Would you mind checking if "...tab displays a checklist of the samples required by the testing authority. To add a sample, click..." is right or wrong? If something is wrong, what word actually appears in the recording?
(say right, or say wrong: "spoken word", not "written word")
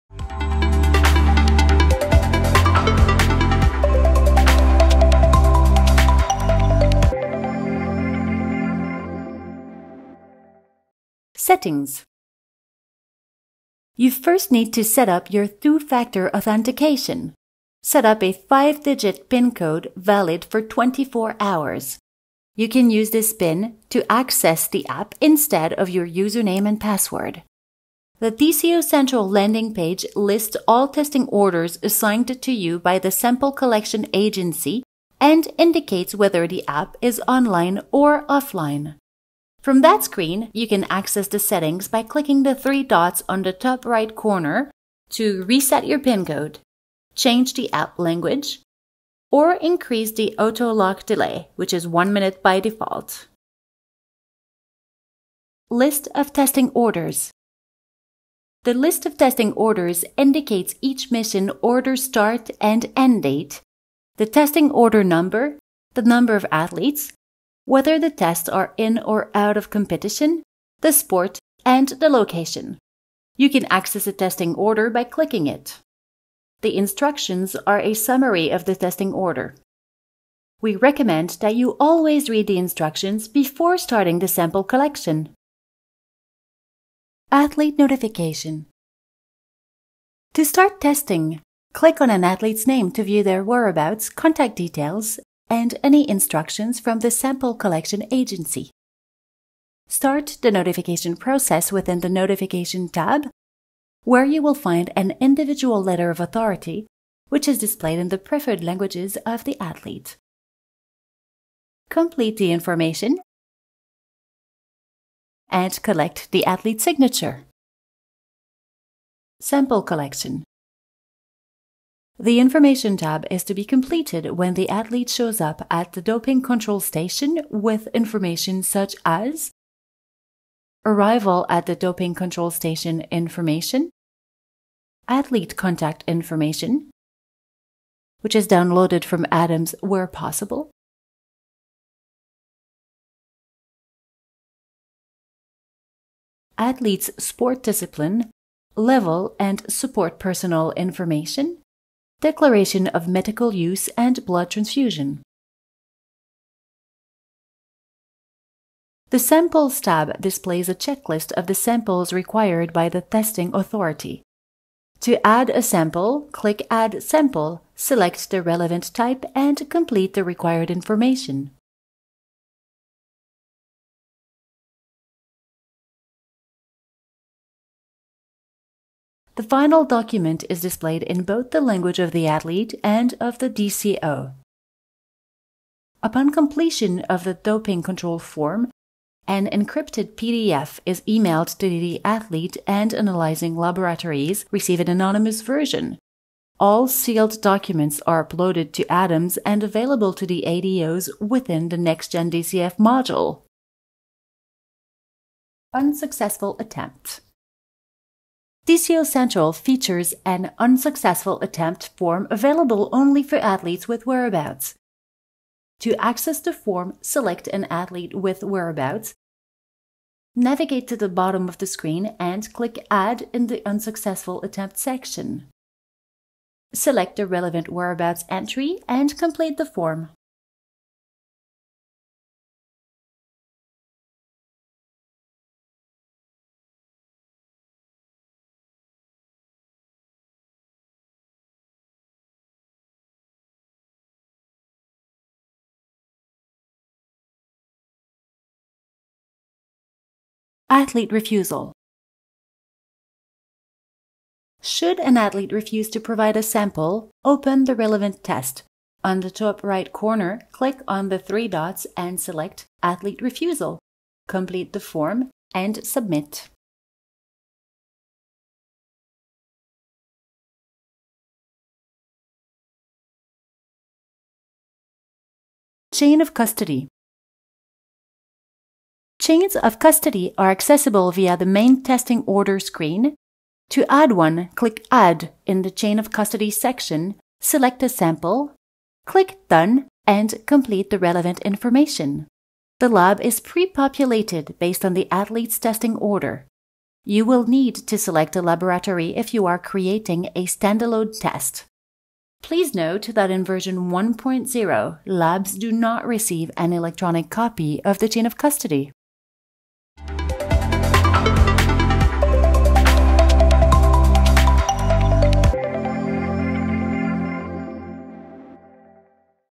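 right.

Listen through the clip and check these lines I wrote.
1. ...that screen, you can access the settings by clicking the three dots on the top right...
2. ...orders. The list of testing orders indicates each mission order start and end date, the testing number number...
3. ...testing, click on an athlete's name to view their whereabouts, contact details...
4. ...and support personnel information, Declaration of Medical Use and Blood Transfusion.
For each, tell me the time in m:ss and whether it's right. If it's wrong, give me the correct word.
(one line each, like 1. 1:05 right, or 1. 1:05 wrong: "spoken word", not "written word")
1. 0:39 right
2. 0:56 wrong: "order", not "number"
3. 1:30 right
4. 2:29 right.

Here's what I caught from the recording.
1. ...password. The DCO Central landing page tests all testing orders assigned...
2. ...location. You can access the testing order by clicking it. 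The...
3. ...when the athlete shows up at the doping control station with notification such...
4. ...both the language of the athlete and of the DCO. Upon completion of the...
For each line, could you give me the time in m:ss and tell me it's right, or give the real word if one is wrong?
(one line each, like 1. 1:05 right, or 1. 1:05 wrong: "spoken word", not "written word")
1. 0:26 wrong: "lists", not "tests"
2. 1:12 right
3. 2:04 wrong: "information", not "notification"
4. 3:01 right.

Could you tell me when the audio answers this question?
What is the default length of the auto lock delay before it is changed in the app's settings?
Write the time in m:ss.
0:51.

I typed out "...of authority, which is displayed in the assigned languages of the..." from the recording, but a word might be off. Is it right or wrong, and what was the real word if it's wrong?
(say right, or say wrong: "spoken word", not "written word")
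wrong: "preferred", not "assigned".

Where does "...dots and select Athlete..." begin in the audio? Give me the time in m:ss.
4:21.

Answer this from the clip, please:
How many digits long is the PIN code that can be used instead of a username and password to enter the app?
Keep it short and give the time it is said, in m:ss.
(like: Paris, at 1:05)
5, at 0:18.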